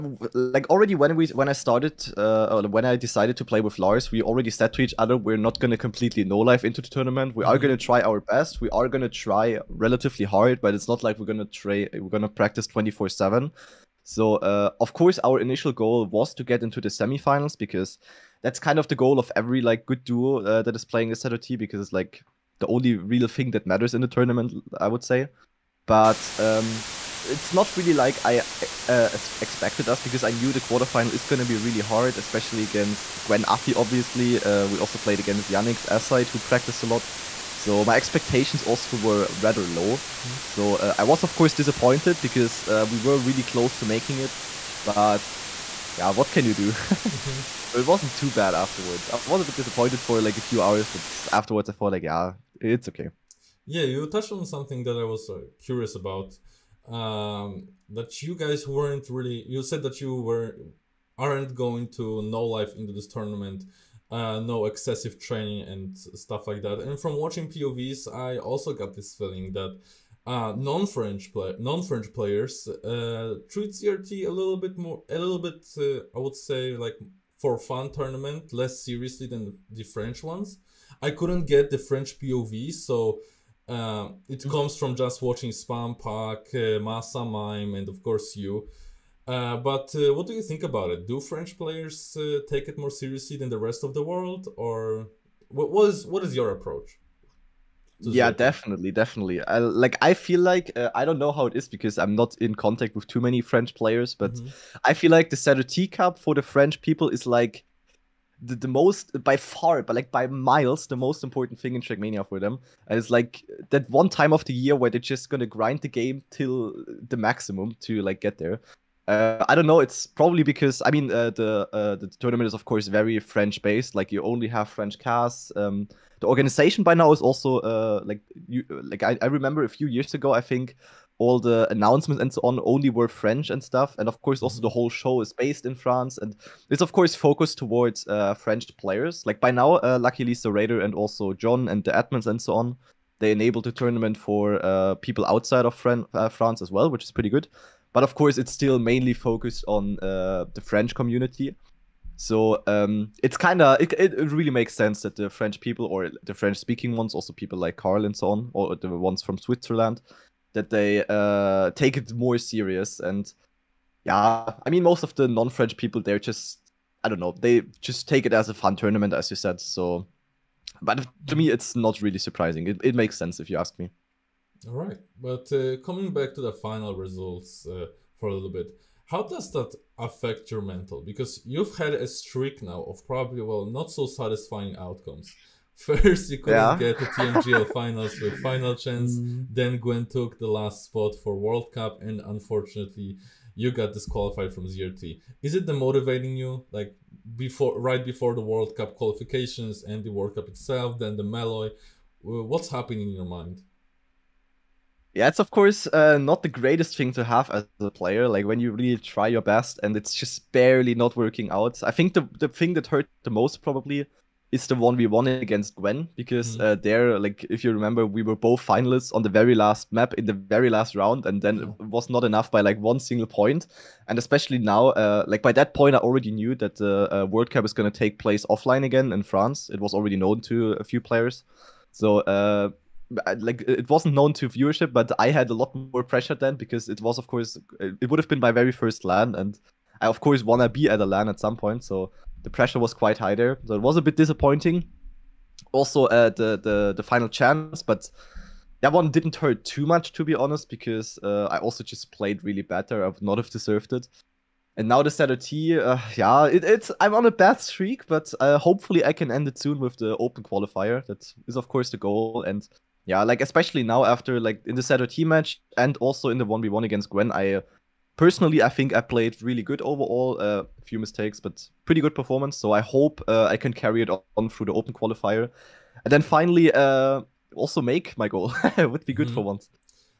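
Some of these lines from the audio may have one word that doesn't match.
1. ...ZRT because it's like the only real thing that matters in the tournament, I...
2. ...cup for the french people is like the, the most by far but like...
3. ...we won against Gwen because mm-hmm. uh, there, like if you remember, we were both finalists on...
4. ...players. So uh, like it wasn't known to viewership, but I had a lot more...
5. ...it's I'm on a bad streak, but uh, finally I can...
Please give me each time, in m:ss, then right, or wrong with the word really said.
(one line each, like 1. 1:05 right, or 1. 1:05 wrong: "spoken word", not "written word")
1. 0:21 right
2. 1:45 right
3. 3:34 right
4. 3:50 right
5. 4:16 wrong: "hopefully", not "finally".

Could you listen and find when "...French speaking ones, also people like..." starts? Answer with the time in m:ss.
2:36.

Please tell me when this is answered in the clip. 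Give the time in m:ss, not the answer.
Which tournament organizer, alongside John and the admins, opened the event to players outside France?
2:20.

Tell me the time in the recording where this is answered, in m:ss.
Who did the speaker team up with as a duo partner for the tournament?
0:03.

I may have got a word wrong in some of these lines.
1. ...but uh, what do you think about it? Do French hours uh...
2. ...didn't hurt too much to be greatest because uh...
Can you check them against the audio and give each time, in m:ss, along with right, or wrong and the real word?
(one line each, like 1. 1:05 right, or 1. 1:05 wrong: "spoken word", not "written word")
1. 1:29 wrong: "players", not "hours"
2. 4:09 wrong: "honest", not "greatest".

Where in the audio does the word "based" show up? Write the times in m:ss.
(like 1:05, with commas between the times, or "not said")
2:03, 2:15.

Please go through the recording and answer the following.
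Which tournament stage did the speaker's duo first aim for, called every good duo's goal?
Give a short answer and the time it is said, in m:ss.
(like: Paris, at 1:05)
semifinals, at 0:16.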